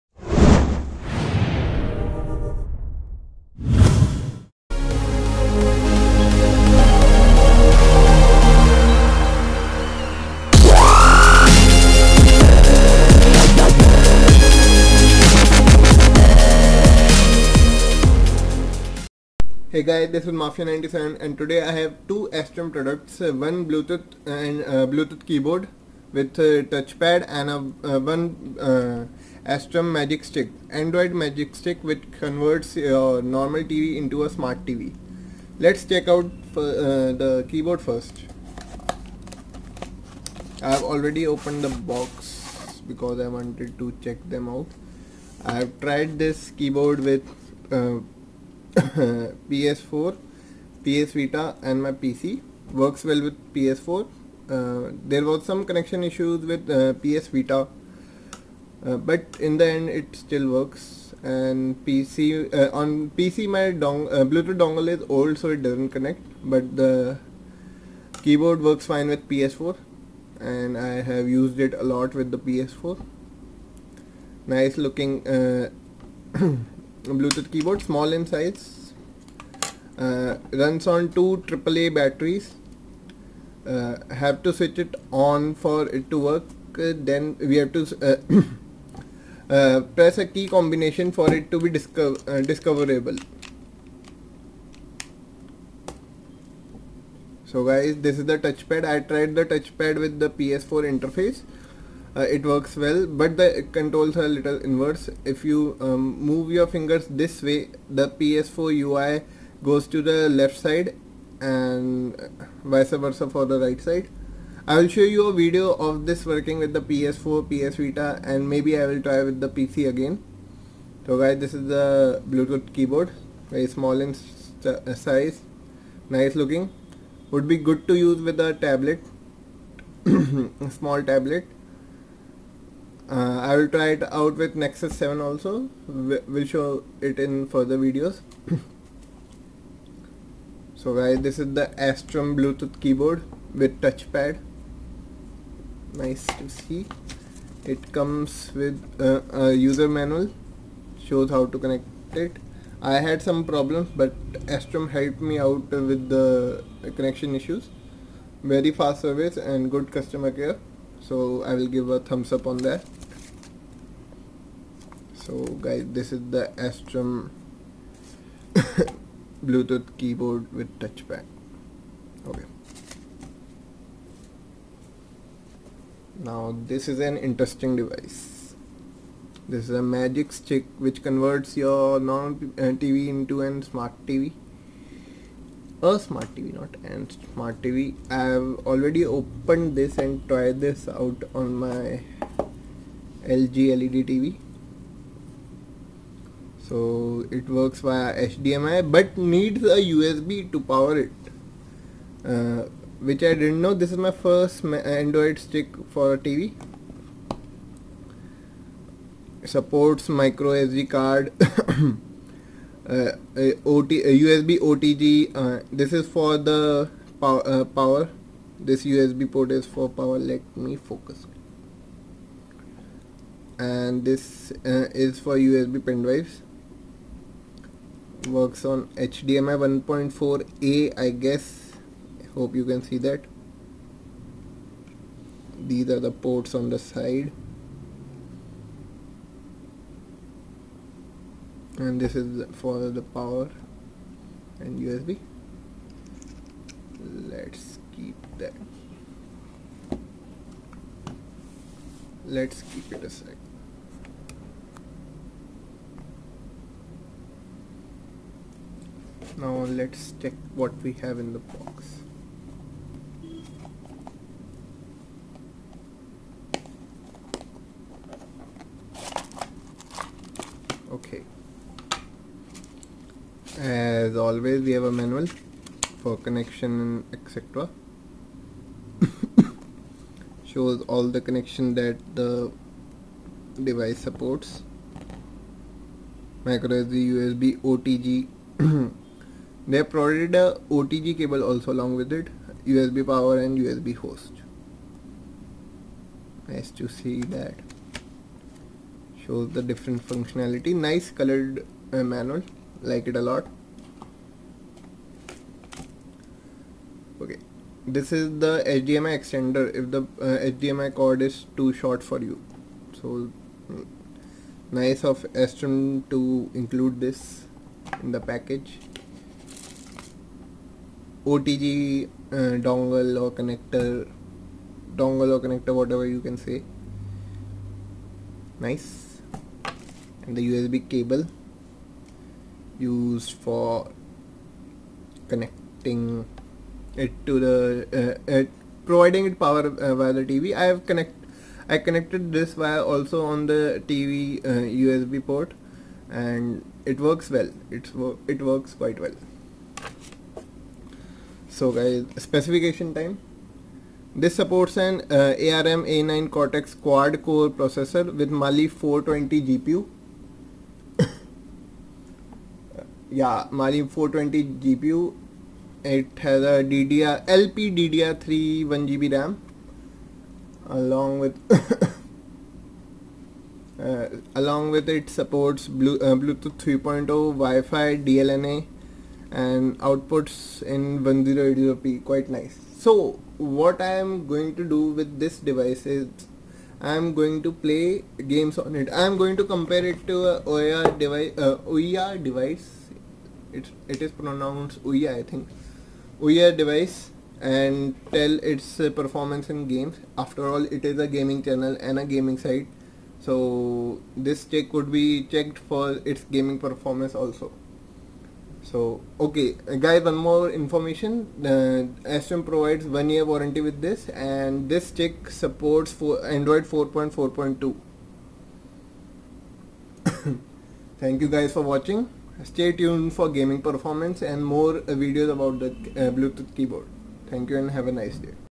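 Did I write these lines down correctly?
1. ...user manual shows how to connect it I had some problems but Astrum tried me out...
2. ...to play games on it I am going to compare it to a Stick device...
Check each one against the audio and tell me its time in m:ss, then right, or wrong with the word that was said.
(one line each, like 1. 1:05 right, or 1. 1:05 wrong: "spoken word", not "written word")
1. 2:29 wrong: "helped", not "tried"
2. 6:27 wrong: "Ouya", not "Stick".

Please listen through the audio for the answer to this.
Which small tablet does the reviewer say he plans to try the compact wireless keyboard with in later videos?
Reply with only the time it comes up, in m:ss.
2:14.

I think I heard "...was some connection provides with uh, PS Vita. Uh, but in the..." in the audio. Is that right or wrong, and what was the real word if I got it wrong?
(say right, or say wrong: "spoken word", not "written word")
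wrong: "issues", not "provides".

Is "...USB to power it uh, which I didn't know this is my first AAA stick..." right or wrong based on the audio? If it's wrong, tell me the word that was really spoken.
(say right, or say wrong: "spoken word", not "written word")
wrong: "Android", not "AAA".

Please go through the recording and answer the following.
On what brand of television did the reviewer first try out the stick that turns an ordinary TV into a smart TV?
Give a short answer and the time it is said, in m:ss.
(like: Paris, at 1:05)
LG, at 3:13.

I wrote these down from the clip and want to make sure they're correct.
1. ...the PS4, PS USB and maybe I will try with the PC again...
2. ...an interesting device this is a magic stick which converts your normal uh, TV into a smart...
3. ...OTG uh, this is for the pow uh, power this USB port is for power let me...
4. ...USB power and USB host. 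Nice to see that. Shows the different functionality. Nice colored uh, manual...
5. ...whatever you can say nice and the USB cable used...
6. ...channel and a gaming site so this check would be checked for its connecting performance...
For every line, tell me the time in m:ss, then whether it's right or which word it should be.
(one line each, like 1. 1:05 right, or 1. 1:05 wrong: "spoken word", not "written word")
1. 1:56 wrong: "Vita", not "USB"
2. 2:56 right
3. 3:34 right
4. 4:52 right
5. 5:25 right
6. 6:41 wrong: "gaming", not "connecting".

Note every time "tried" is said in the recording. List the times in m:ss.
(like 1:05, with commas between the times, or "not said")
0:45, 1:39, 3:10.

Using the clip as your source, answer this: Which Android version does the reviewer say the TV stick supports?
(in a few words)
Android 4.4.2.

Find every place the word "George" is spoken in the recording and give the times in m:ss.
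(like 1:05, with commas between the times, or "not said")
not said.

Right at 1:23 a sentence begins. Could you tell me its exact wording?
Uh, have to switch it on for it to work.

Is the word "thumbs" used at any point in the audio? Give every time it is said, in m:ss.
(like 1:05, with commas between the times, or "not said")
2:41.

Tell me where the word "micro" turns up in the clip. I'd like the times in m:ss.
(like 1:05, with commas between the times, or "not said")
3:30, 4:46.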